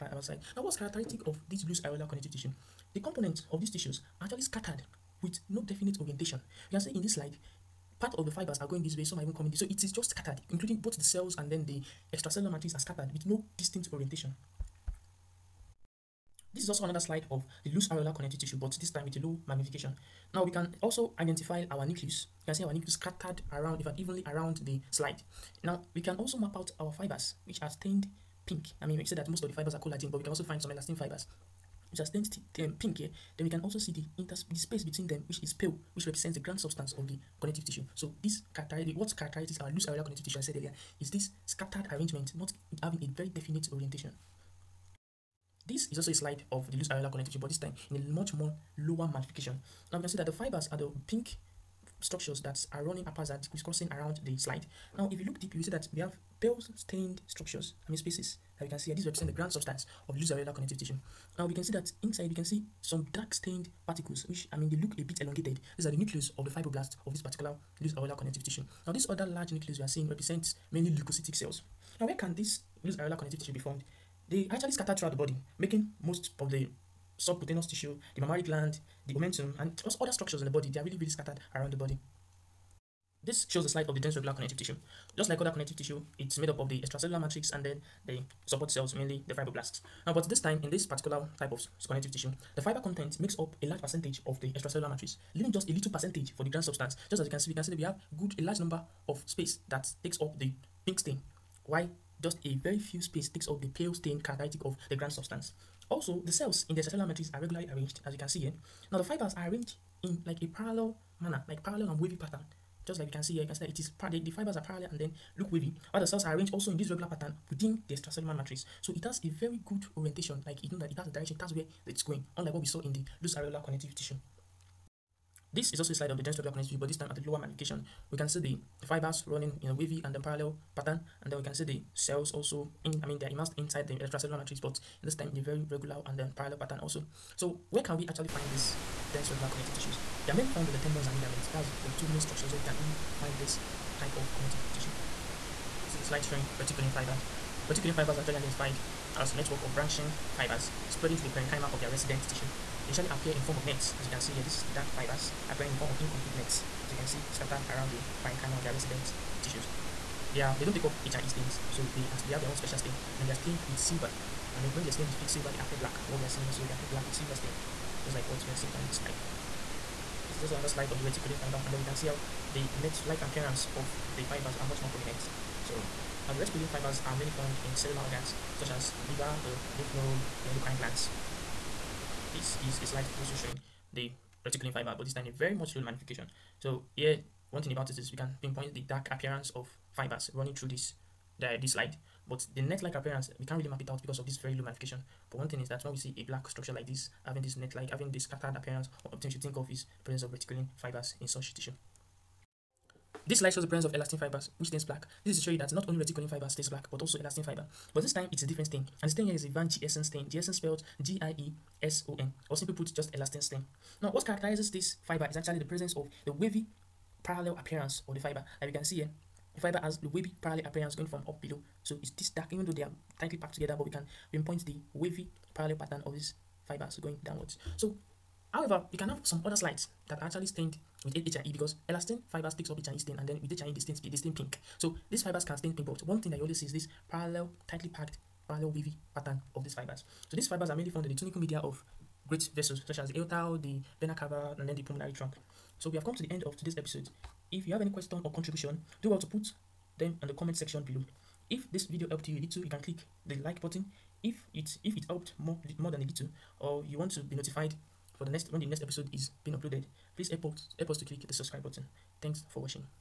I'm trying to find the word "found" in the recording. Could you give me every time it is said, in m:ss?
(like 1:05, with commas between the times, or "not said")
2:20, 2:57, 4:00.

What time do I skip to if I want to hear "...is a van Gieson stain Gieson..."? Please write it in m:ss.
3:29.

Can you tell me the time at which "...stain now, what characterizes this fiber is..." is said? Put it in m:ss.
3:33.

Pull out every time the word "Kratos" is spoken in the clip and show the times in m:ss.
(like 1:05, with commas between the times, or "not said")
not said.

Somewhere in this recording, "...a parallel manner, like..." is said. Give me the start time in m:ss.
1:50.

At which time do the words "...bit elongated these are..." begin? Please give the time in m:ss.
1:05.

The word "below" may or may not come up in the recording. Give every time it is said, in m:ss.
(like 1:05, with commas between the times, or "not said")
3:41, 4:10.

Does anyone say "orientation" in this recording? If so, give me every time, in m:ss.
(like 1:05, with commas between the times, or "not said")
0:05, 0:13, 0:43, 1:59.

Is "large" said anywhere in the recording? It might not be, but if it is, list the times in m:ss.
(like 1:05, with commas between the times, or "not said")
1:09, 1:33, 1:38.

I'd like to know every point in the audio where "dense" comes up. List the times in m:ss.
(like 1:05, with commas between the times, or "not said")
1:23, 2:06, 2:19.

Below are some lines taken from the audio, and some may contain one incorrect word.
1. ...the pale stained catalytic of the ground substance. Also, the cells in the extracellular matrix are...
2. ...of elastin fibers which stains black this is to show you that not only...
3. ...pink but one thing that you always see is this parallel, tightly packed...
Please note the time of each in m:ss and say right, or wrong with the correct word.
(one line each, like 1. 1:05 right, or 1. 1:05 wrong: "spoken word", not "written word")
1. 1:43 right
2. 3:23 right
3. 3:55 right.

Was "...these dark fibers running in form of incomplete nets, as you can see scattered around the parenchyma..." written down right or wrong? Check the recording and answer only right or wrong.
wrong.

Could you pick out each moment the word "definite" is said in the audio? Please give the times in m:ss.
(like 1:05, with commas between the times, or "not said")
0:05, 0:43.